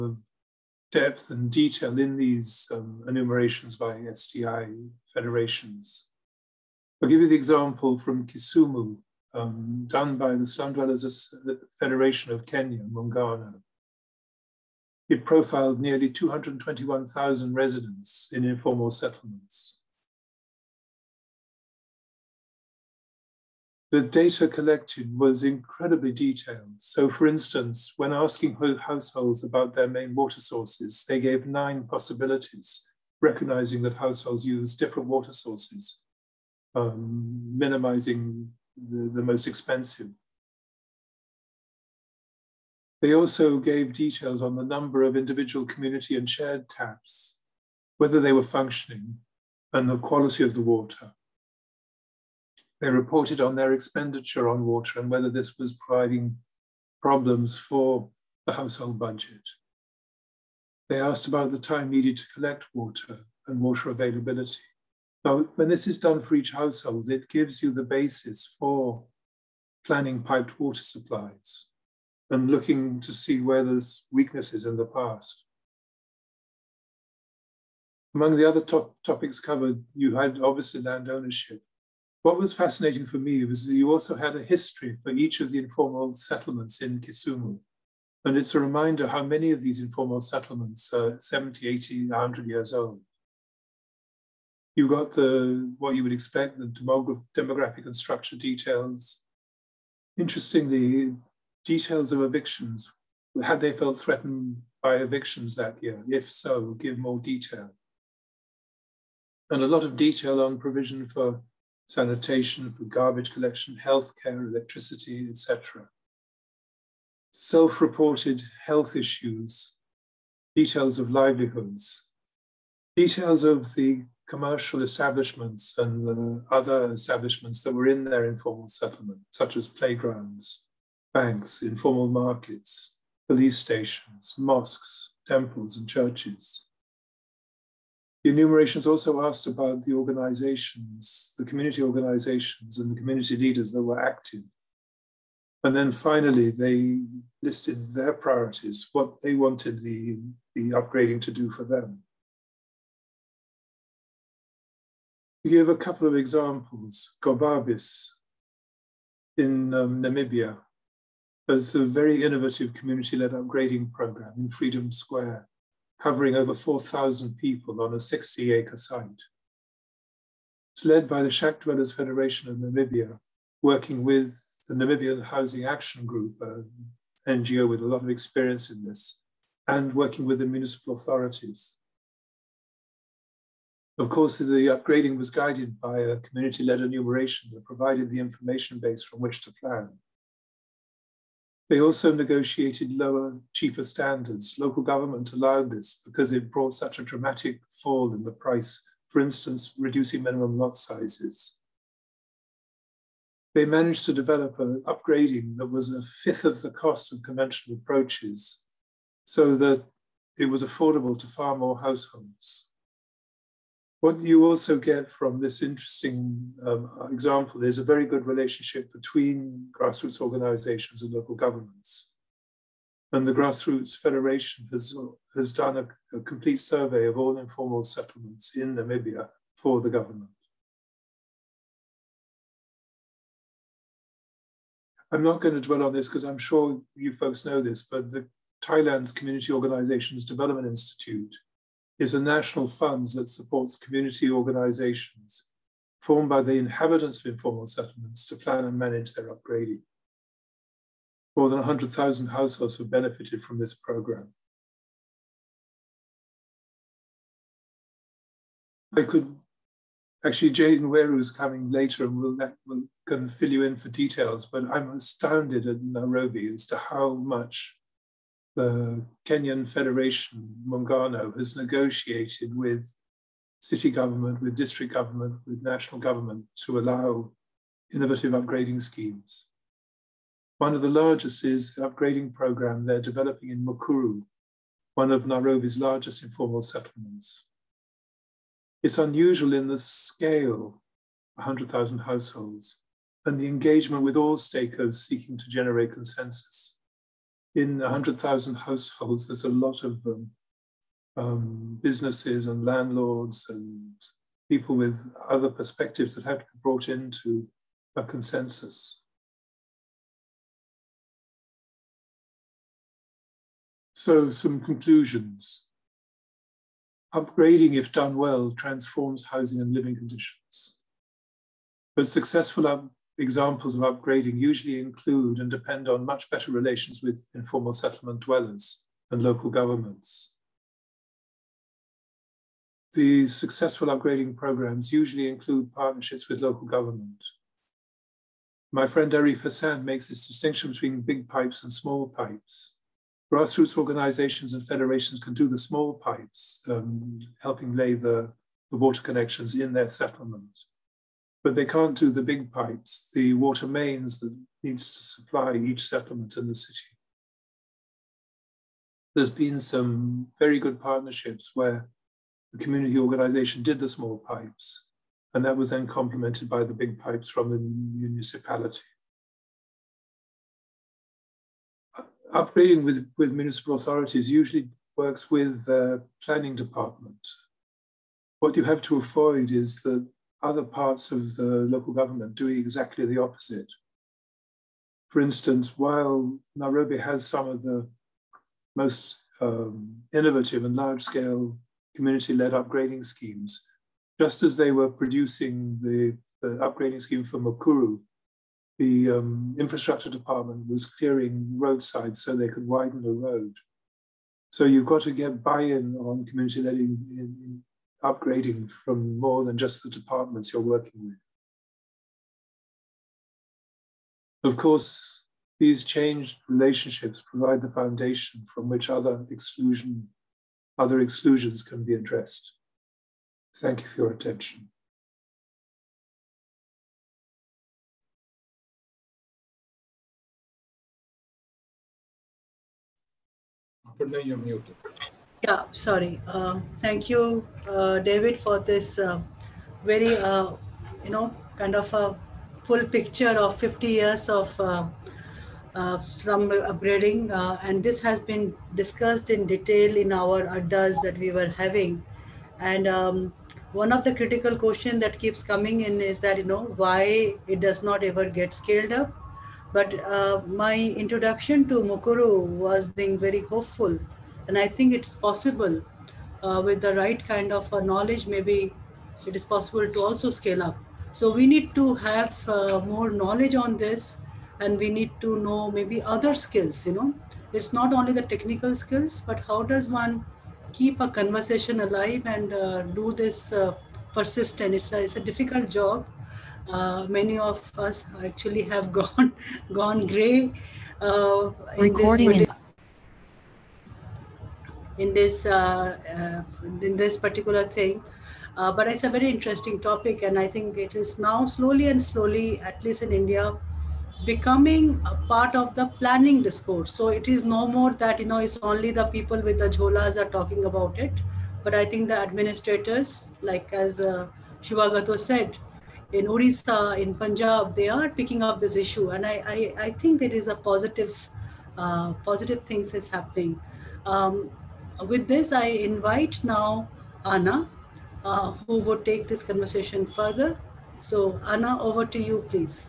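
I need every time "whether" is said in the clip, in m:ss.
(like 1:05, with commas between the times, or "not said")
0:47, 0:55.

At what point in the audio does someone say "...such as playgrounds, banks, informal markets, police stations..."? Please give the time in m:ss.
2:09.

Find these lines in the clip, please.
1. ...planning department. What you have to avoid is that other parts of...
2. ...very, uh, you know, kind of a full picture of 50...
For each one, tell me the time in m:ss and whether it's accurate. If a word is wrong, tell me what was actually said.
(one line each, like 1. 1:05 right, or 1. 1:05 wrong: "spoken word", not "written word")
1. 6:16 right
2. 7:19 right.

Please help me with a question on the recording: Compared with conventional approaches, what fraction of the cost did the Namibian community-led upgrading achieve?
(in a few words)
a fifth.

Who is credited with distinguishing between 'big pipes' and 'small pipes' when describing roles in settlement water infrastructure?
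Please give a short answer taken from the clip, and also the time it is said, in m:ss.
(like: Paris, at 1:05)
Arif Hassan, at 5:39.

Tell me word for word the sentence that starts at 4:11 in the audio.
More than 100,000 households have benefited from this program.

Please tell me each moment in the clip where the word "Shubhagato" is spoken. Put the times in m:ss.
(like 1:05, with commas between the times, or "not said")
8:34.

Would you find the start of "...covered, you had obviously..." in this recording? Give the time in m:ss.
1:19.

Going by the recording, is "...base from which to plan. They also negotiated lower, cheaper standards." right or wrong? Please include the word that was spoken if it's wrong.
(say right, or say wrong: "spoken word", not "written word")
right.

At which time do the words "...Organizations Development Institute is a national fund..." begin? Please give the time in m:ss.
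3:59.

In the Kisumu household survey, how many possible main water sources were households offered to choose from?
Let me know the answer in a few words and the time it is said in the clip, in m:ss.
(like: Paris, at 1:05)
9, at 0:31.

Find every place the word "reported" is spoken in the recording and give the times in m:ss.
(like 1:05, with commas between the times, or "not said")
0:52, 1:57.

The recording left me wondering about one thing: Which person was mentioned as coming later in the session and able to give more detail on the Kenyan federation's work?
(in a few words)
Jane Weru.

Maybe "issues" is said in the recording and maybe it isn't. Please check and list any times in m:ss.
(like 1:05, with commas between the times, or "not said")
1:58, 8:38.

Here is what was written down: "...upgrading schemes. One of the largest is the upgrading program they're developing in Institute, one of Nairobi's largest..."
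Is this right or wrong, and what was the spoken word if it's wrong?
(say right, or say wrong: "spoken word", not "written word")
wrong: "Mukuru", not "Institute".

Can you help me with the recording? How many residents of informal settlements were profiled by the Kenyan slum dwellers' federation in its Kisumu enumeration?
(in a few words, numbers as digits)
221,000.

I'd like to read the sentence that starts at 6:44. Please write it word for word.
So you've got to get buy-in on community-led in, in, upgrading from more than just the departments you're working with.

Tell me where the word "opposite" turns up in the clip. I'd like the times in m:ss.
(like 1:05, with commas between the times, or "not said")
6:23.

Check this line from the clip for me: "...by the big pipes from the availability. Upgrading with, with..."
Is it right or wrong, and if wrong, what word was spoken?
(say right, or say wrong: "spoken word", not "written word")
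wrong: "municipality", not "availability".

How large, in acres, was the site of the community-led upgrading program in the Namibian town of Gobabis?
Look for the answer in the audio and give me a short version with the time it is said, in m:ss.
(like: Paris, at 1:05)
60 acres, at 2:47.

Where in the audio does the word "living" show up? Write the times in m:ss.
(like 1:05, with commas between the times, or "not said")
5:19.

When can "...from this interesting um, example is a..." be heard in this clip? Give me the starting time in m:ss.
3:35.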